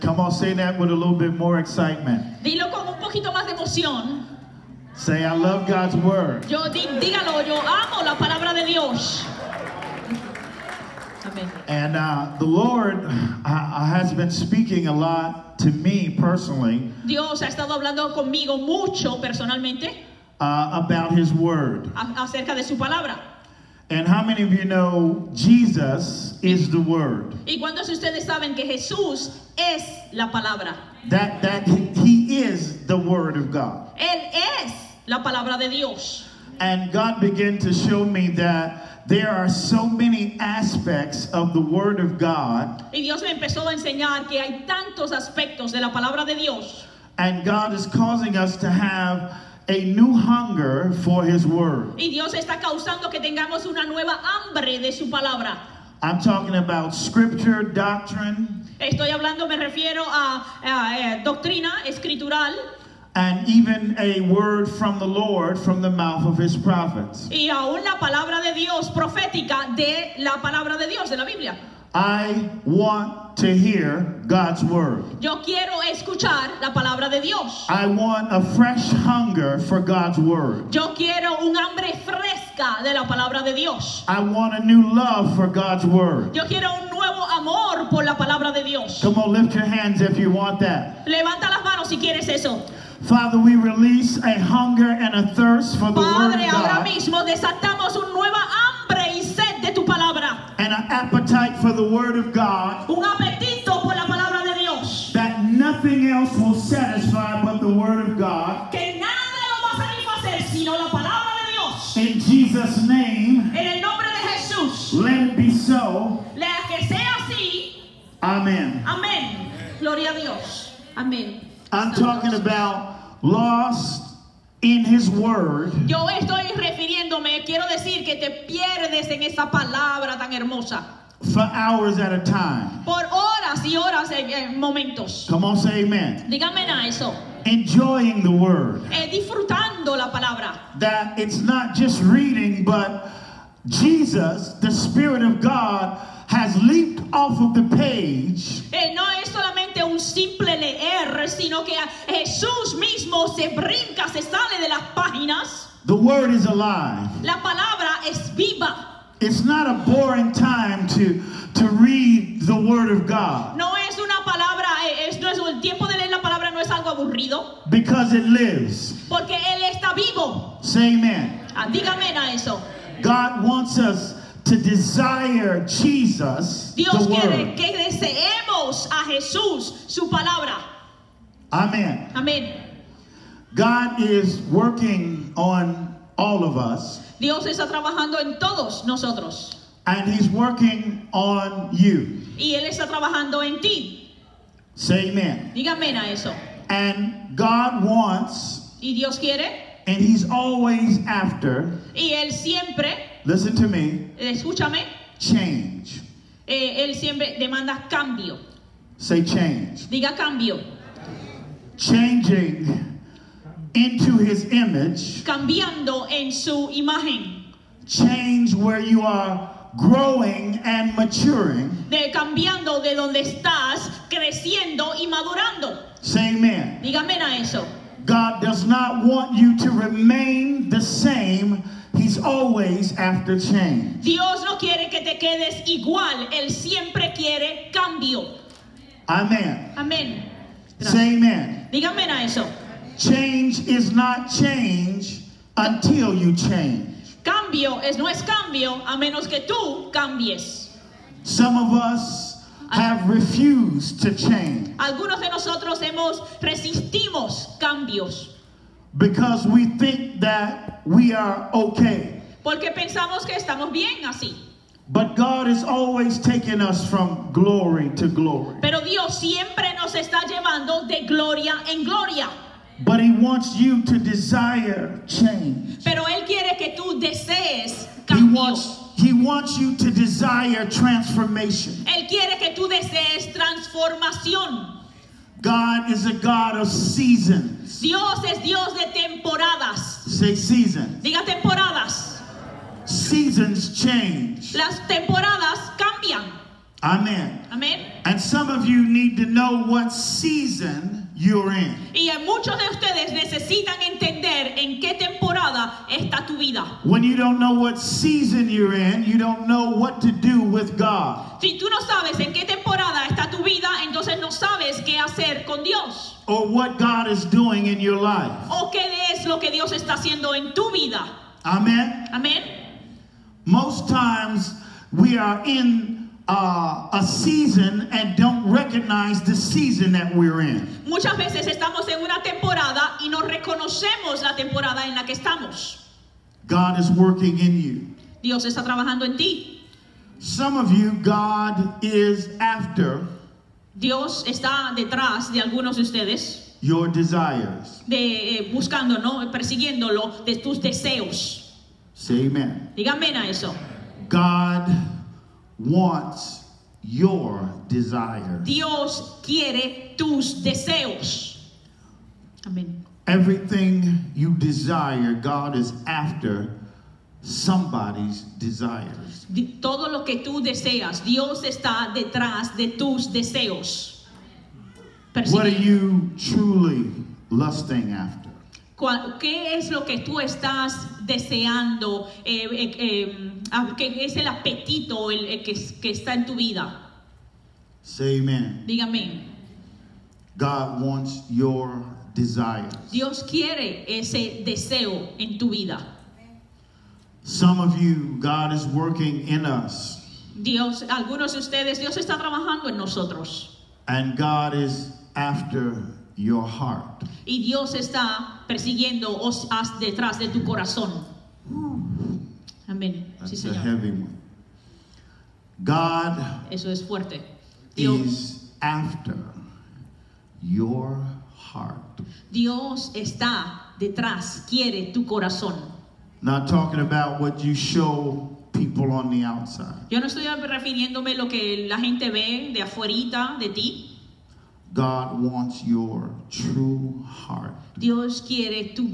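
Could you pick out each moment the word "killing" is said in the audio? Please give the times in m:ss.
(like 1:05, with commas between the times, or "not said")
not said.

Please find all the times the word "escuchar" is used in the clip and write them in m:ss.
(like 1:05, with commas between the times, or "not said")
1:15.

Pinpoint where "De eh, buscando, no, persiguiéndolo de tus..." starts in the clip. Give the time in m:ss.
5:47.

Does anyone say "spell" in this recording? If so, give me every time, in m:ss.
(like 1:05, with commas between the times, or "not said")
not said.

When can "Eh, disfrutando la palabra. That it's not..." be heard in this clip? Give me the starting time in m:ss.
2:18.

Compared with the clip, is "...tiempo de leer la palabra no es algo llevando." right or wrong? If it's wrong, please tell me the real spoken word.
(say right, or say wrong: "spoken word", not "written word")
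wrong: "aburrido", not "llevando".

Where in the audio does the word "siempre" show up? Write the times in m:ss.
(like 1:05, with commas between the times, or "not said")
3:22, 3:26, 3:56, 4:29.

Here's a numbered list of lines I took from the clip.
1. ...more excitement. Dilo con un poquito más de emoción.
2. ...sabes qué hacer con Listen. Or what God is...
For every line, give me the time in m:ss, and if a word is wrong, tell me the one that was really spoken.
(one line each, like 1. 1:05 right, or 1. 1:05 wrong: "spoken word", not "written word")
1. 0:01 right
2. 5:14 wrong: "Dios", not "Listen".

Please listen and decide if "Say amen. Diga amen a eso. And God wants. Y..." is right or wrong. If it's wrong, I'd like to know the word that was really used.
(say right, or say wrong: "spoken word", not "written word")
right.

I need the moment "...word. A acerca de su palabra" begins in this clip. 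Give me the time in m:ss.
0:21.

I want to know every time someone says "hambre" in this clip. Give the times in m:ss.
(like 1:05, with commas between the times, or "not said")
0:54, 1:21.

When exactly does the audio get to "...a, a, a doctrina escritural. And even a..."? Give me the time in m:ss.
1:00.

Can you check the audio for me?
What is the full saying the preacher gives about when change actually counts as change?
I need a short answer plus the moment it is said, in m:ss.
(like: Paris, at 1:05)
Change is not change until you change, at 4:02.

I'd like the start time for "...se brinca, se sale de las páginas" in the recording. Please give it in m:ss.
2:33.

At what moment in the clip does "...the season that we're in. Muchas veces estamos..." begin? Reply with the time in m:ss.
5:29.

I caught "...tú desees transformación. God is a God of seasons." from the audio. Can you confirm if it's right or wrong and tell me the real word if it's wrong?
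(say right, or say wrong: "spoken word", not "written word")
right.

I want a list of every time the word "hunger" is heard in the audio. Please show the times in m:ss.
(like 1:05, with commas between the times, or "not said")
0:50, 1:18, 1:34.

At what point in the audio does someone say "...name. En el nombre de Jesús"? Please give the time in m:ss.
1:52.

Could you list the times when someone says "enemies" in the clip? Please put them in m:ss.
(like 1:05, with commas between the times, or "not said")
not said.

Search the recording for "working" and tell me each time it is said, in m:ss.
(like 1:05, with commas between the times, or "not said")
3:04, 3:10, 5:36, 6:38.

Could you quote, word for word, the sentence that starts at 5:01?
Y muchos de ustedes necesitan entender en qué temporada está tu vida.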